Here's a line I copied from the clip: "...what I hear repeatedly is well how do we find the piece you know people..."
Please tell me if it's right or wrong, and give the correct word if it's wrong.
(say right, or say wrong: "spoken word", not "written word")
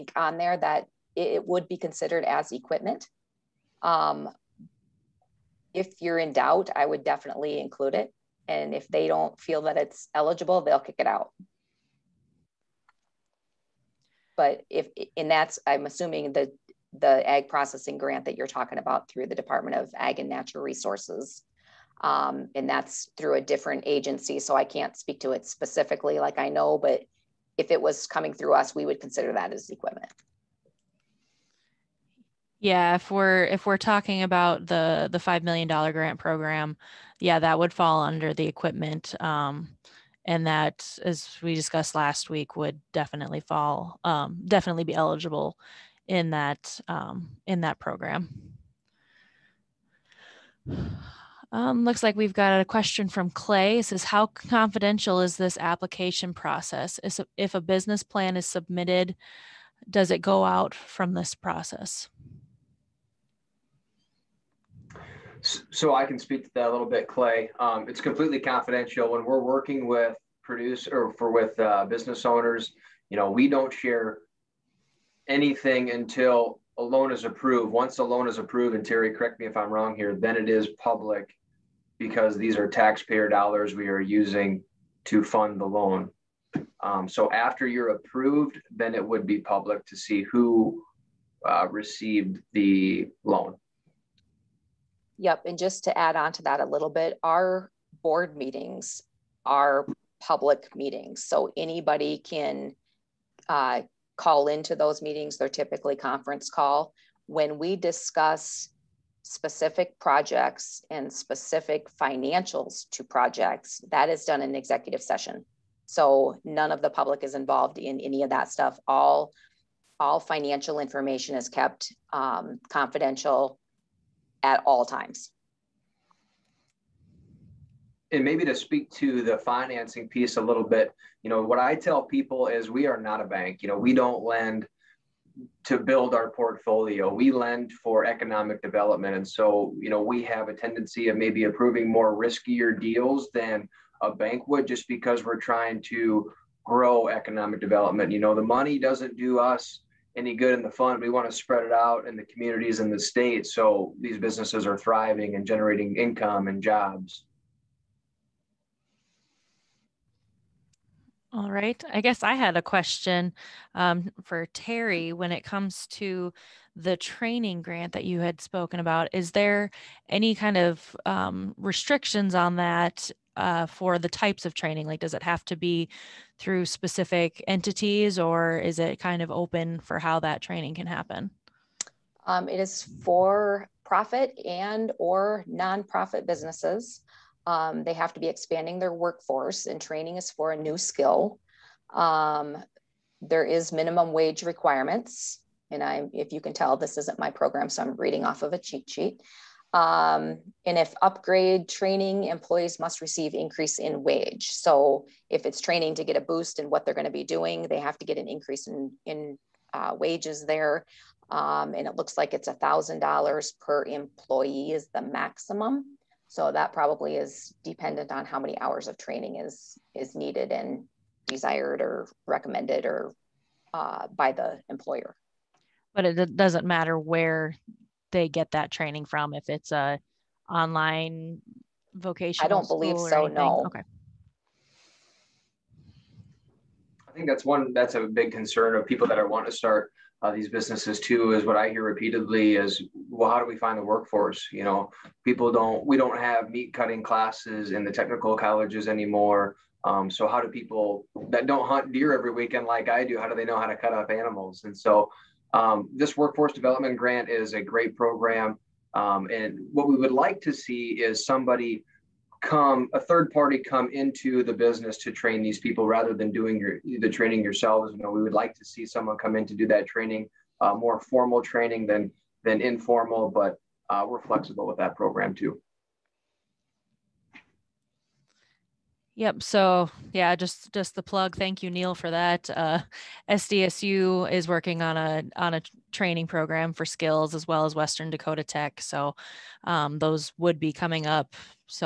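wrong: "workforce", not "piece".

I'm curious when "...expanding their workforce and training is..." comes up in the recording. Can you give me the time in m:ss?
3:08.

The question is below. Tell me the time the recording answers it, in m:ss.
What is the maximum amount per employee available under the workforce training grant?
3:32.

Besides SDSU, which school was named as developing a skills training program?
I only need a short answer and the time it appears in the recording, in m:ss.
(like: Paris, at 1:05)
Western Dakota Tech, at 4:47.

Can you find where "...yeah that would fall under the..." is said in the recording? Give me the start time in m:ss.
0:37.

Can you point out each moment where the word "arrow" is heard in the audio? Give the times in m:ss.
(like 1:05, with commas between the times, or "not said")
not said.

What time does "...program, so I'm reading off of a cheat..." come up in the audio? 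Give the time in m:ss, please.
3:17.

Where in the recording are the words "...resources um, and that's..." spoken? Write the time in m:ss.
0:20.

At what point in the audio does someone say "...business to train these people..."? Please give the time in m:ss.
4:24.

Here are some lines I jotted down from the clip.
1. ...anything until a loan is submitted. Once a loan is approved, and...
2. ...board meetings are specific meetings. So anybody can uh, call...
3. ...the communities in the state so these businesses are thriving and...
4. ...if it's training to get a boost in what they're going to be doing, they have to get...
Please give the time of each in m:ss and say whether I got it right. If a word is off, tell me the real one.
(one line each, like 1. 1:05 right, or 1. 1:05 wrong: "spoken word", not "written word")
1. 1:15 wrong: "approved", not "submitted"
2. 1:38 wrong: "public", not "specific"
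3. 2:32 right
4. 3:25 right.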